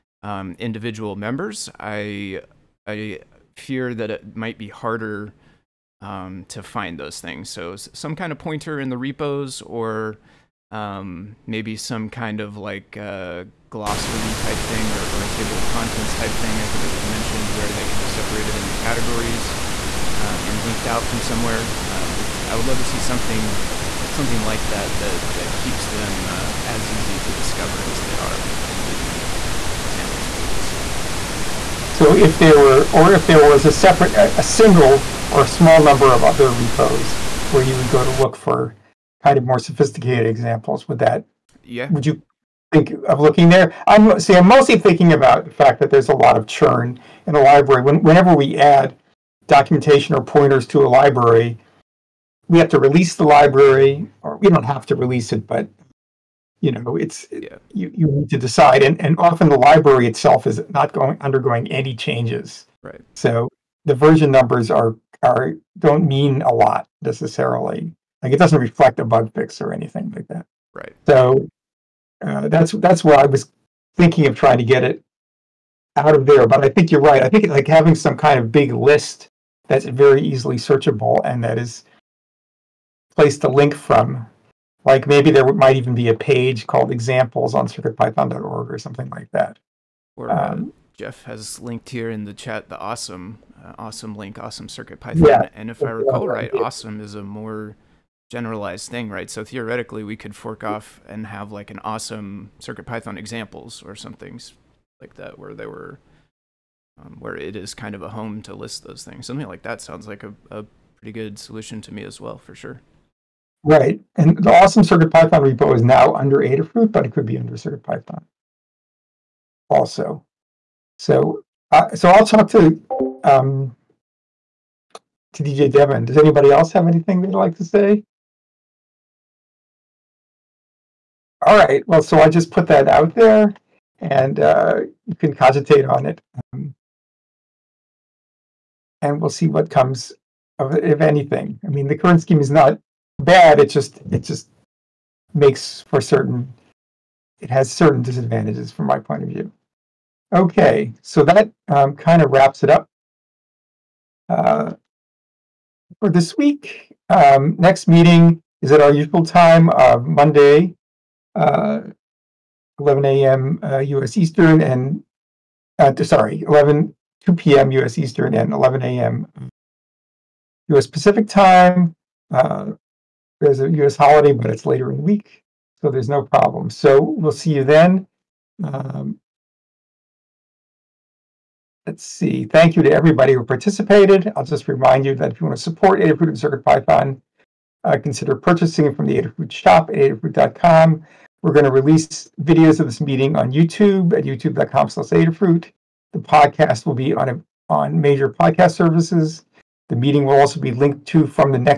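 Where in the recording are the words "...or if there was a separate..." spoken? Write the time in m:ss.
0:32.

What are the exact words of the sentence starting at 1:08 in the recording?
Like it doesn't reflect a bug fix or anything like that.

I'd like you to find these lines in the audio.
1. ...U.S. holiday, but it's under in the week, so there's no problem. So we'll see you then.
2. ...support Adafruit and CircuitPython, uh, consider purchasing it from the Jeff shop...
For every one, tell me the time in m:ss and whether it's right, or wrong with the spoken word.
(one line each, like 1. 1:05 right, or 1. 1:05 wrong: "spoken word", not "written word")
1. 2:53 wrong: "later", not "under"
2. 3:05 wrong: "Adafruit", not "Jeff".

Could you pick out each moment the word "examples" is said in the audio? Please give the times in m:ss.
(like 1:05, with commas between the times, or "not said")
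0:29, 0:40, 1:26, 1:43.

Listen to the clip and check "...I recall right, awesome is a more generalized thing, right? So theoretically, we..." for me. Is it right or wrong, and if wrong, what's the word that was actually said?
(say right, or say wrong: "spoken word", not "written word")
right.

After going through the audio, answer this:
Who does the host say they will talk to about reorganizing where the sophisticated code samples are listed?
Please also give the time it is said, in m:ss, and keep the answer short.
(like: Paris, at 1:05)
DJ Devon, at 2:05.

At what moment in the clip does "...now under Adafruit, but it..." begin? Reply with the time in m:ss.
1:55.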